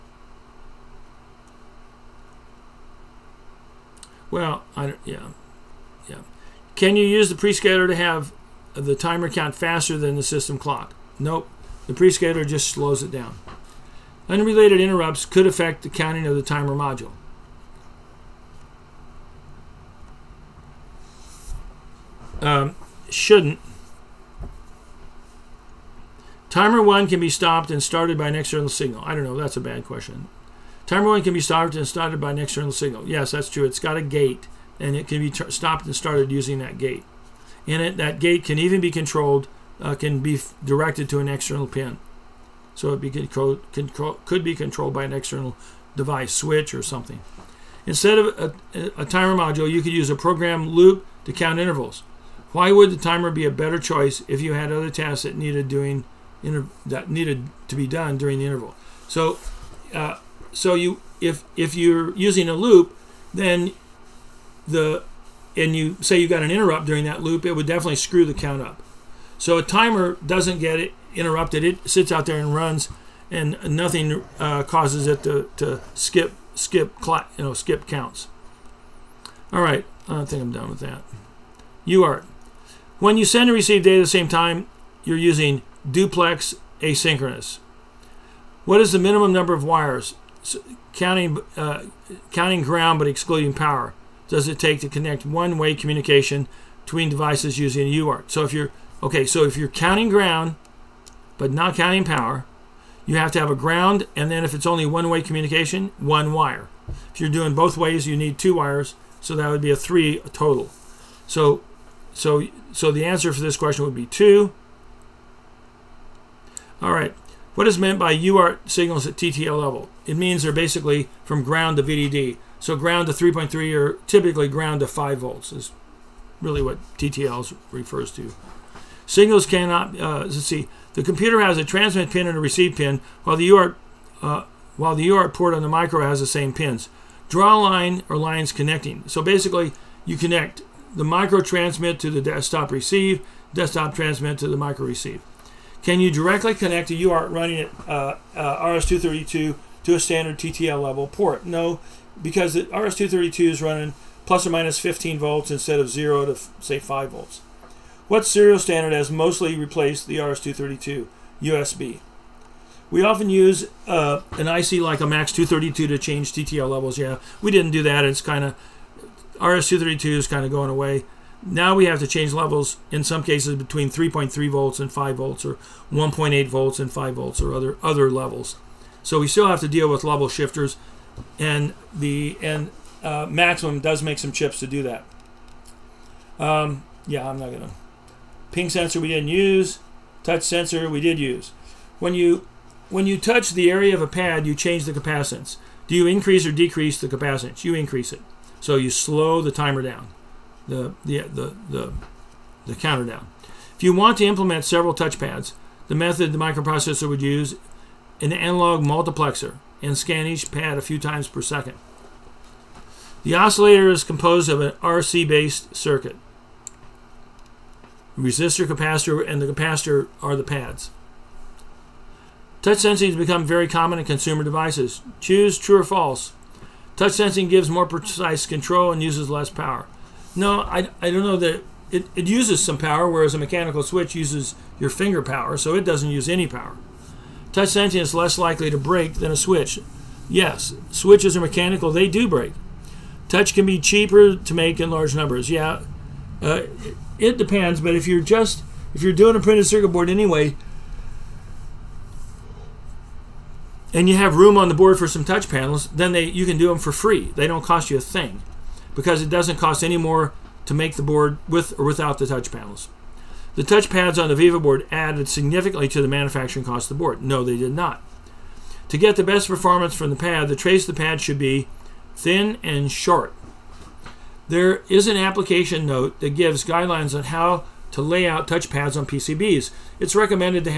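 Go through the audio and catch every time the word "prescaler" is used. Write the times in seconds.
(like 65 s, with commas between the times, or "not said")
7 s, 11 s.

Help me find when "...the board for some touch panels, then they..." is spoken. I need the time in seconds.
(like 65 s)
254 s.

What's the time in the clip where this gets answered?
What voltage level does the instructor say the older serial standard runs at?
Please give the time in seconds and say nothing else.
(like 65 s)
154 s.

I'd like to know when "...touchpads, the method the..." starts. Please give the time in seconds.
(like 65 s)
204 s.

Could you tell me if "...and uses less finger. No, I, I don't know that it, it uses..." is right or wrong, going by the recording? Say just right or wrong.
wrong.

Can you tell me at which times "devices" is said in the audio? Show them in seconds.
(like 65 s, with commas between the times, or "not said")
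45 s, 97 s, 224 s.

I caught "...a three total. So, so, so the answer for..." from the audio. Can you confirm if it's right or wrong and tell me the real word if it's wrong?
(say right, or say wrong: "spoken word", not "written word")
right.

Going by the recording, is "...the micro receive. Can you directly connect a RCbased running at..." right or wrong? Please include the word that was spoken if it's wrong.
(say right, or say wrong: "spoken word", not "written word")
wrong: "UART", not "RCbased".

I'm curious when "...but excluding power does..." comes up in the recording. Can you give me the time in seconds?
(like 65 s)
92 s.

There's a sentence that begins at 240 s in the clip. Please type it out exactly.
Yes, switches are mechanical, they do break.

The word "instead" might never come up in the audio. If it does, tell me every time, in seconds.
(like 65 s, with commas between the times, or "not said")
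47 s, 155 s.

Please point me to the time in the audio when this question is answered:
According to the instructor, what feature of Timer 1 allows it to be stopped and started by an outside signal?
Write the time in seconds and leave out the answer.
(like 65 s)
33 s.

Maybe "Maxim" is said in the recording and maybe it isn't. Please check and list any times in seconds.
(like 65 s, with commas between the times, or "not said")
183 s.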